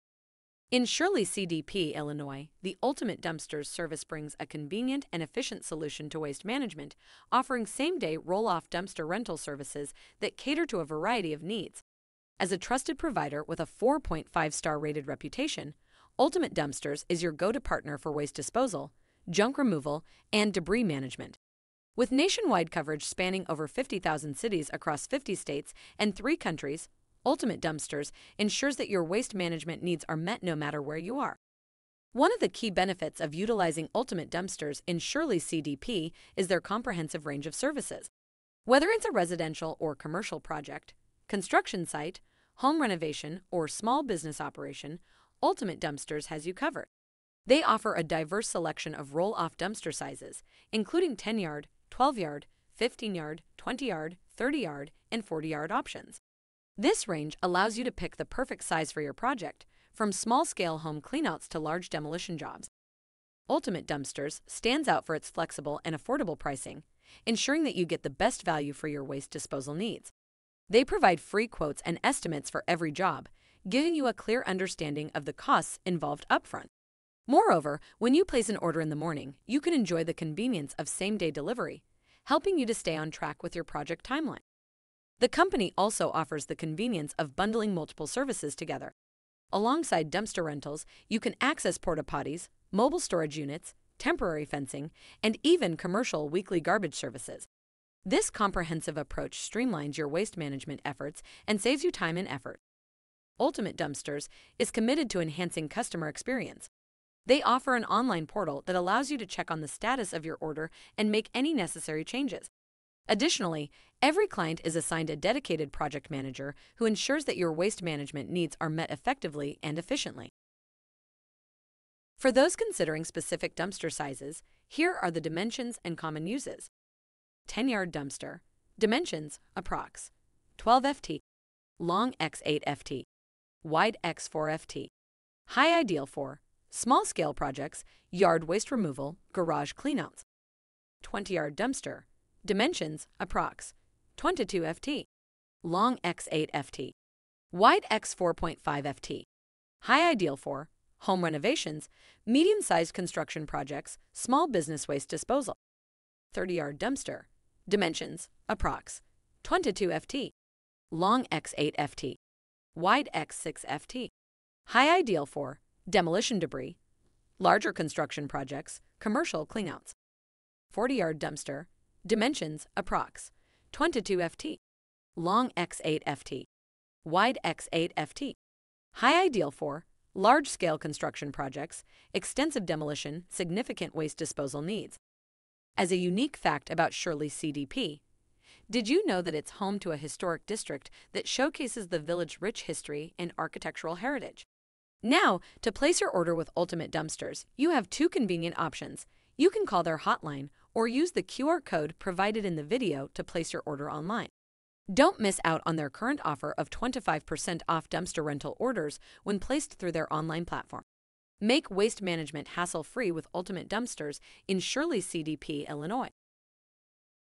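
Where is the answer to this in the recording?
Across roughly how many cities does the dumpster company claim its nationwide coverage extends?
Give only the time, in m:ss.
0:23.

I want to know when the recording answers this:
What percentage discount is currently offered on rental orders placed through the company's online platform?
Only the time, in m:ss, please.
3:26.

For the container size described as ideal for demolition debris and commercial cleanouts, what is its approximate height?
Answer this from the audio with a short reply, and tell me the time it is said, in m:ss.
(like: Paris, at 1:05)
6 ft, at 2:43.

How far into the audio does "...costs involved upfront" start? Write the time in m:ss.
1:15.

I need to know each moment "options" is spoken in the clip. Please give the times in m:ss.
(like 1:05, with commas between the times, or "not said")
0:55, 3:18.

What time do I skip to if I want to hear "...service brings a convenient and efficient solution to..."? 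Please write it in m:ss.
0:03.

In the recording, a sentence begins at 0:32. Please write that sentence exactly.
One of the key benefits of utilizing Ultimate Dumpsters in Shirley CDP is their comprehensive range of services.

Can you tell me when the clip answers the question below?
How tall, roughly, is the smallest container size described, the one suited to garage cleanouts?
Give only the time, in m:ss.
2:14.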